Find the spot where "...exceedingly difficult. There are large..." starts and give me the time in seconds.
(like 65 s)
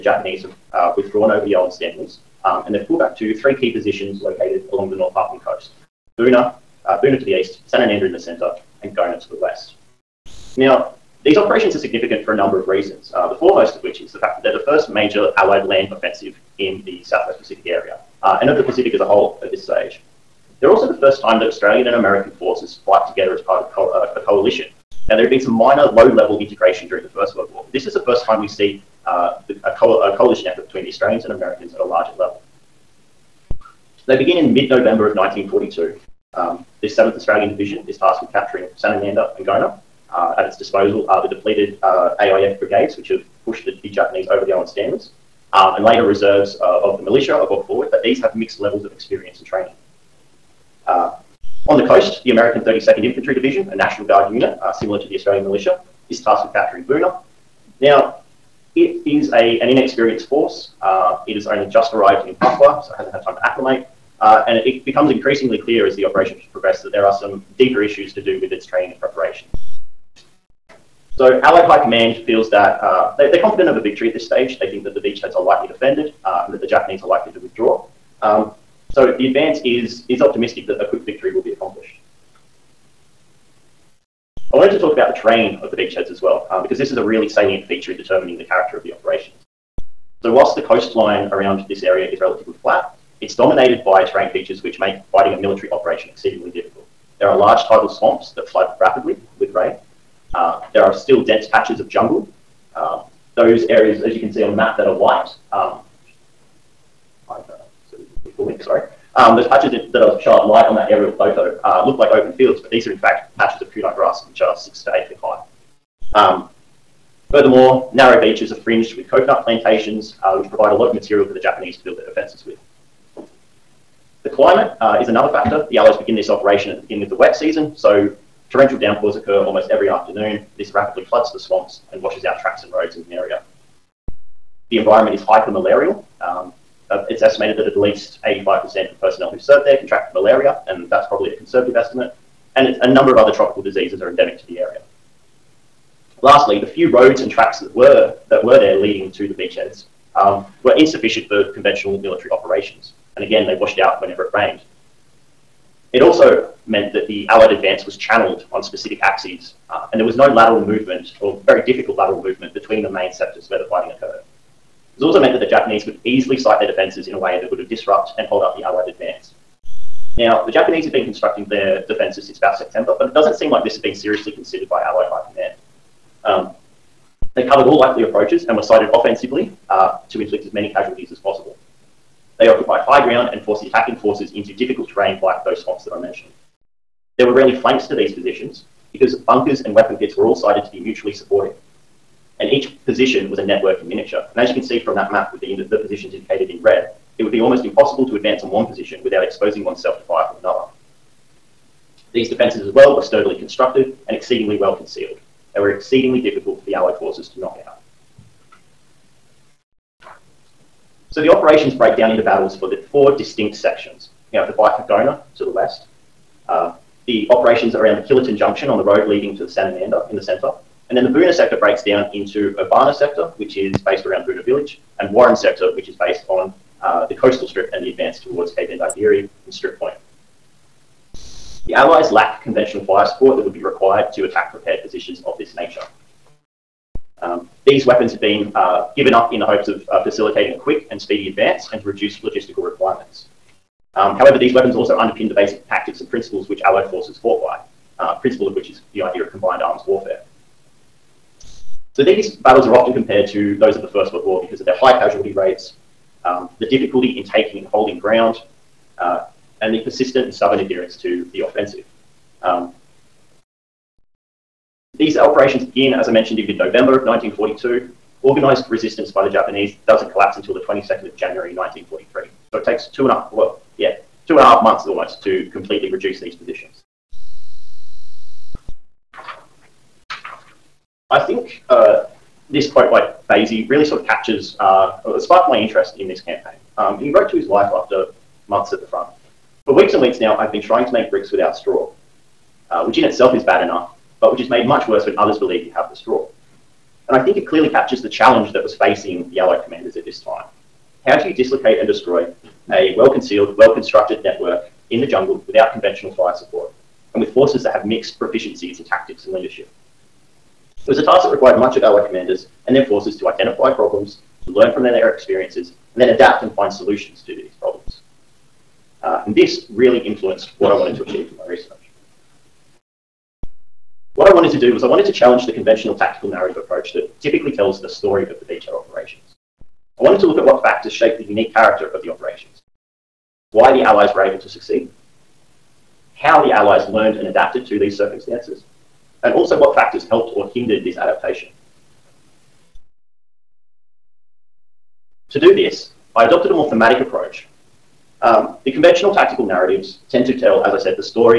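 96 s.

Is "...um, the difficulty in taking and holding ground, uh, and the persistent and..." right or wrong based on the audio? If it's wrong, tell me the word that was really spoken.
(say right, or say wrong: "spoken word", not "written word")
right.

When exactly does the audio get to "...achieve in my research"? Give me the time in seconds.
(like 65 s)
321 s.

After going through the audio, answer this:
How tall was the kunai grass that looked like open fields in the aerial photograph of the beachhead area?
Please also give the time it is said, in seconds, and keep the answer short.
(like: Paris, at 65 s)
6 to 8 feet, at 114 s.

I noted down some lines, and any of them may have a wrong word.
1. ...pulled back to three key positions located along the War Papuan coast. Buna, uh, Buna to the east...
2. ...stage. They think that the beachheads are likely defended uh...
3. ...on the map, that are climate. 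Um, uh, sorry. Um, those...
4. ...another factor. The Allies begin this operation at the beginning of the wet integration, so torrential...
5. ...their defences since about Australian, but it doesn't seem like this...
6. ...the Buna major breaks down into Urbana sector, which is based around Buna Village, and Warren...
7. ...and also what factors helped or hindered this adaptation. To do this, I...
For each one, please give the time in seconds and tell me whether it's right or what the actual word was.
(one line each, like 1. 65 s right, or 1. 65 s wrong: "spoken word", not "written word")
1. 2 s wrong: "North", not "War"
2. 74 s right
3. 104 s wrong: "white", not "climate"
4. 125 s wrong: "season", not "integration"
5. 171 s wrong: "September", not "Australian"
6. 221 s wrong: "sector", not "major"
7. 339 s right.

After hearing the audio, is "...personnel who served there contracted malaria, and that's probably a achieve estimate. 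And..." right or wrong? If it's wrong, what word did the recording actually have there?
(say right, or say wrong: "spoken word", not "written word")
wrong: "conservative", not "achieve".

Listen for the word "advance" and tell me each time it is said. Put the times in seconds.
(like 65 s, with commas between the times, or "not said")
79 s, 157 s, 168 s, 198 s, 227 s, 241 s.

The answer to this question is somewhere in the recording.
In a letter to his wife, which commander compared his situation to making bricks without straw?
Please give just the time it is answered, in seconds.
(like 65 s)
283 s.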